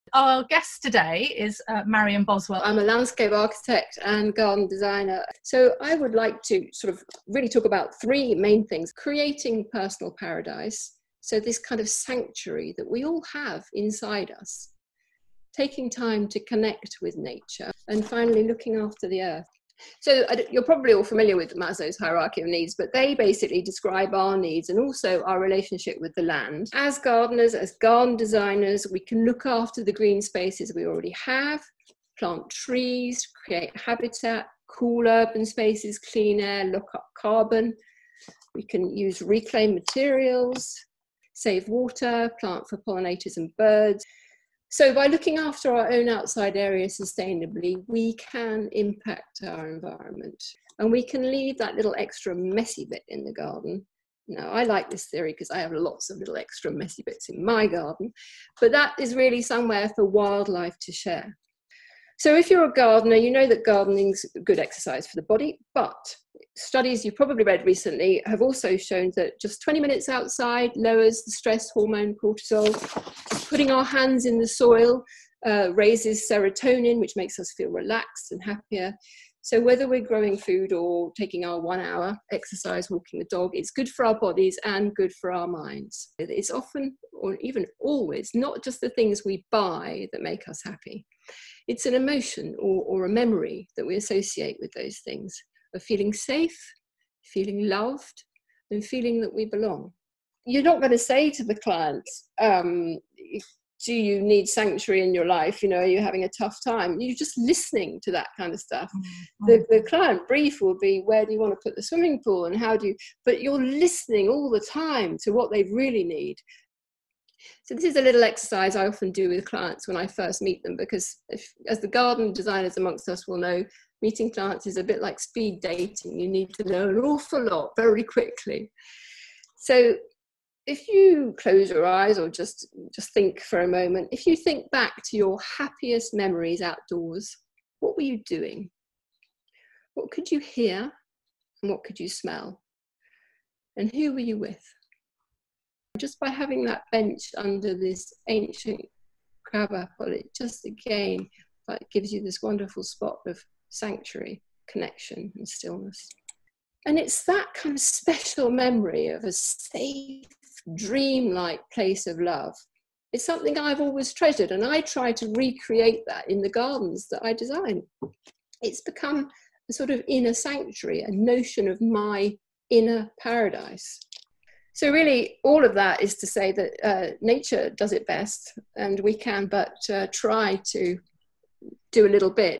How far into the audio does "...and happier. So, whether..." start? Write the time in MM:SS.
01:18.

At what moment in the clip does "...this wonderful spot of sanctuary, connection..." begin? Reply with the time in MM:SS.
02:32.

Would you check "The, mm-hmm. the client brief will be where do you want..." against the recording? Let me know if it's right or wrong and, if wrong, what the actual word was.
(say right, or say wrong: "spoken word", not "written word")
right.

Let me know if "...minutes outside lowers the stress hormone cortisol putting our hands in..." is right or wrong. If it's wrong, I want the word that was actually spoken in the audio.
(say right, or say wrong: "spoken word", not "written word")
right.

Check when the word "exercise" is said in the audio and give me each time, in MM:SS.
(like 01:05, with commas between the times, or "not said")
01:04, 01:22, 01:58.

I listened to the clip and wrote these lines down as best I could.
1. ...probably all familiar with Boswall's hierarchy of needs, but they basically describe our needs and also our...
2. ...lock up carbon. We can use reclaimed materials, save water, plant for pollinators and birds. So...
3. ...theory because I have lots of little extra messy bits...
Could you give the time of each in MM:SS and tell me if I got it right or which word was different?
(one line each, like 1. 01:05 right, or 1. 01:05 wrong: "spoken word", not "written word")
1. 00:20 wrong: "Maslow", not "Boswall"
2. 00:36 right
3. 00:55 right.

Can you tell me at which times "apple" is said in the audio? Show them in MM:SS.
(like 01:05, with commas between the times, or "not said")
02:29.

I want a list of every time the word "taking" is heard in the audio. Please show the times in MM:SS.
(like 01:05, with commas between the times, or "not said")
00:15, 01:21.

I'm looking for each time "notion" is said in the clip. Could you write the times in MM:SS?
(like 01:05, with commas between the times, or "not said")
02:51.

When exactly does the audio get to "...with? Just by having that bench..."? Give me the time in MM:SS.
02:24.